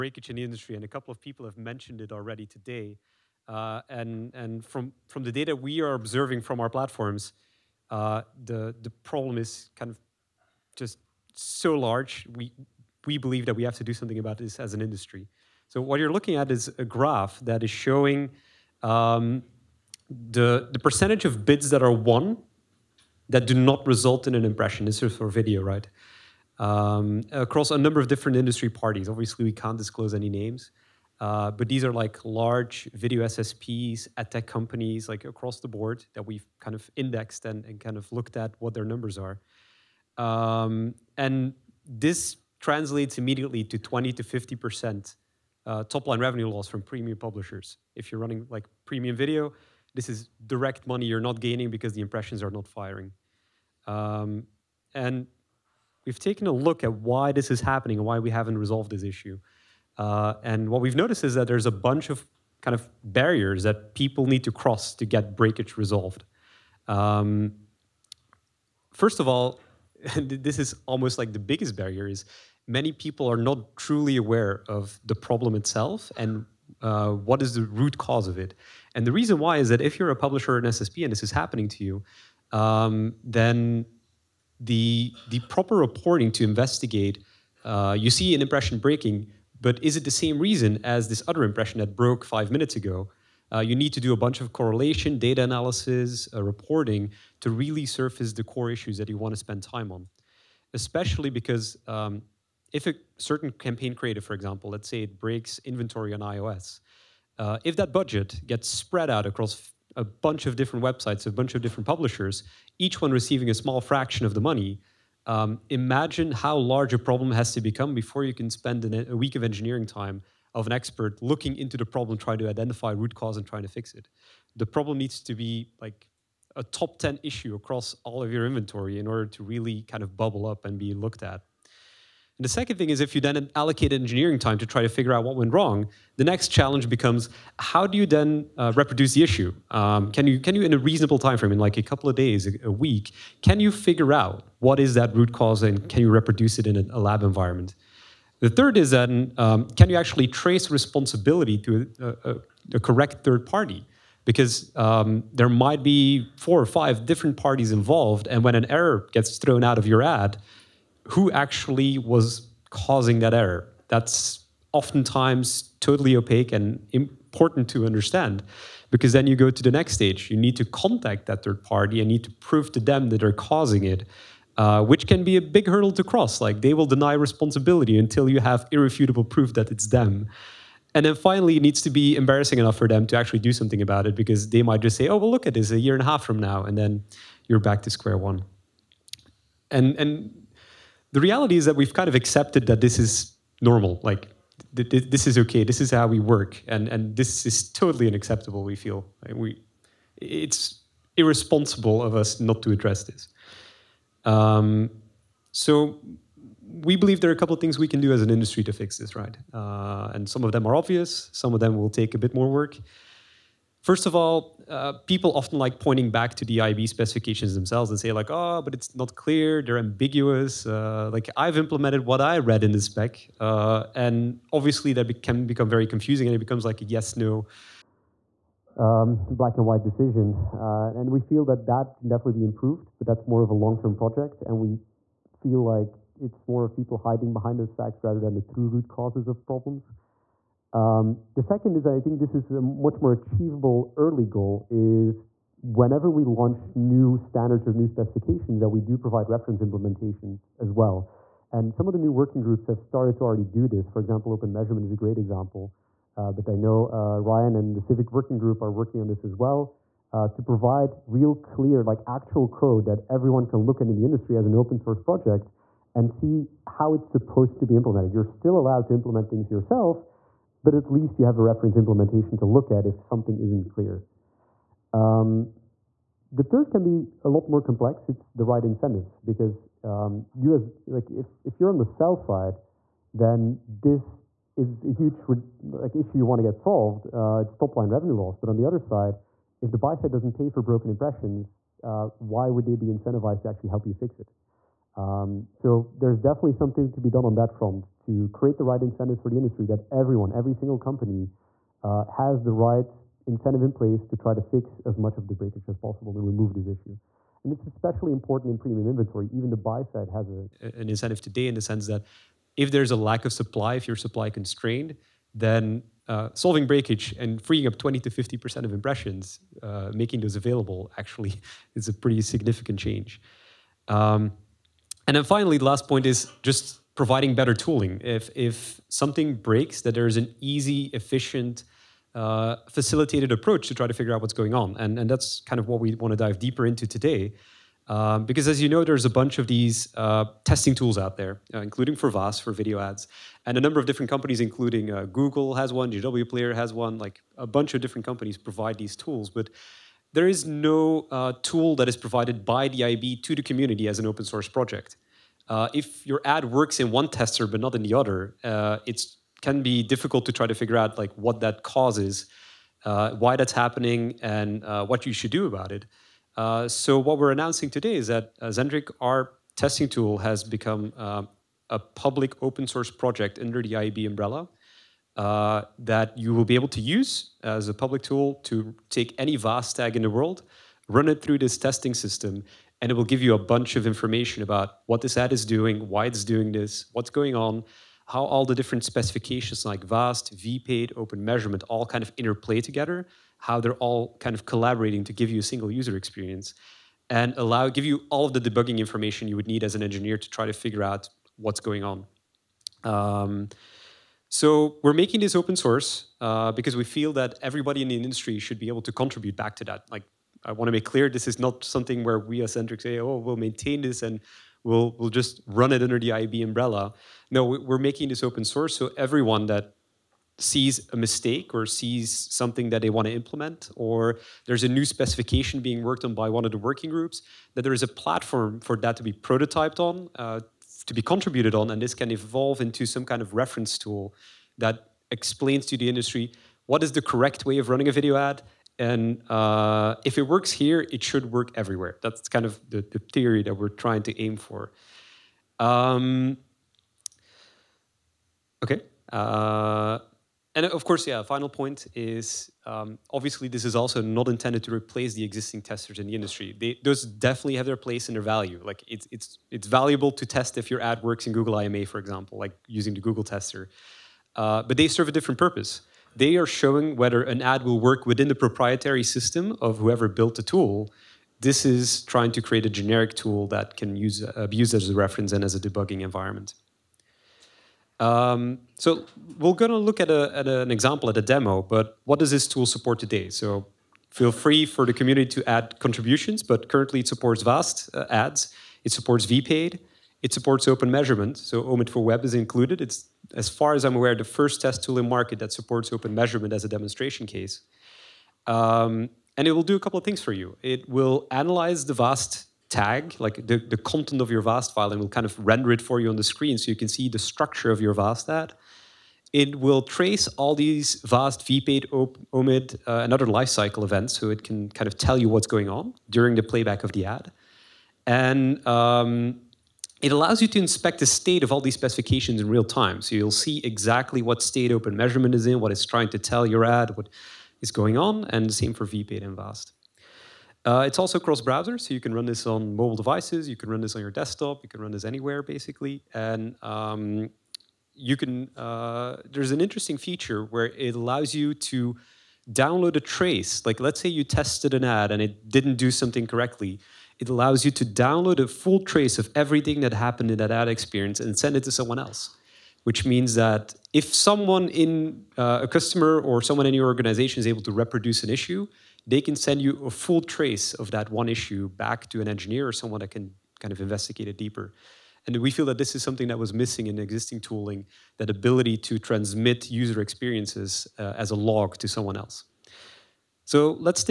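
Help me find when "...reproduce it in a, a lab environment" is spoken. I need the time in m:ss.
2:26.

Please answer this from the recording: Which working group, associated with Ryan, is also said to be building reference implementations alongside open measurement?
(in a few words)
SIVIC Working Group.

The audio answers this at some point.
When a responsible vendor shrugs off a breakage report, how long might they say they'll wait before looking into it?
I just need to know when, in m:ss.
3:05.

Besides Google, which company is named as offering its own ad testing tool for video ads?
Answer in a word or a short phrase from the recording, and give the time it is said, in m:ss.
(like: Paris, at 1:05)
JW Player, at 5:45.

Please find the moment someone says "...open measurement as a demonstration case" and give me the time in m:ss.
8:15.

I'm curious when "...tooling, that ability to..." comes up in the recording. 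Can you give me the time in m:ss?
9:27.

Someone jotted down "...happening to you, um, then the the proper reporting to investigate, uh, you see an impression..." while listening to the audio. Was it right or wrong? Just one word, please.
right.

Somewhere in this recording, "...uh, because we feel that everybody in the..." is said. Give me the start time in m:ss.
6:46.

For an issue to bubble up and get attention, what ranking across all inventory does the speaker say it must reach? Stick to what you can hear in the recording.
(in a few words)
top 10.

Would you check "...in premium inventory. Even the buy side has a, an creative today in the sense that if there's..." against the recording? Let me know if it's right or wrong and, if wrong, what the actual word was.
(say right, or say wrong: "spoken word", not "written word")
wrong: "incentive", not "creative".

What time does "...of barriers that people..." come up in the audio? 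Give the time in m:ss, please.
1:02.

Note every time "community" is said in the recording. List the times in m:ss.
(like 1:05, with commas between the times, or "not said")
5:53, 8:04.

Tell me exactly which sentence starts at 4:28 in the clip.
You're still allowed to implement things yourself, but at least you have a reference implementation to look at if something isn't clear.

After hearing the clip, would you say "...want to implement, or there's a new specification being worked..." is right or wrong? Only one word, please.
right.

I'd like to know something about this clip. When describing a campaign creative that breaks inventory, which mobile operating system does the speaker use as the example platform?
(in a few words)
iOS.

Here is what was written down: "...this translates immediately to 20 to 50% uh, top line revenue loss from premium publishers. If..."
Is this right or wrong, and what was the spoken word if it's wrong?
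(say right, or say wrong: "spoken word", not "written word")
right.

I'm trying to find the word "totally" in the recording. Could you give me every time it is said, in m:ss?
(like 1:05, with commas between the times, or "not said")
2:45, 3:17.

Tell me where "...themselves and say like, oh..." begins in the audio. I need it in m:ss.
3:37.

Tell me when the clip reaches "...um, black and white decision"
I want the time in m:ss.
3:48.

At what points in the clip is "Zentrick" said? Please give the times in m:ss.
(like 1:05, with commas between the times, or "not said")
6:08, 6:52.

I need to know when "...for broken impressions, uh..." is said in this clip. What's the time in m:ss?
4:50.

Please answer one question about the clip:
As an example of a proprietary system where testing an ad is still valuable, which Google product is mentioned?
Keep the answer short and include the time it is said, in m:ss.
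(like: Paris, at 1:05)
Google IMA, at 7:41.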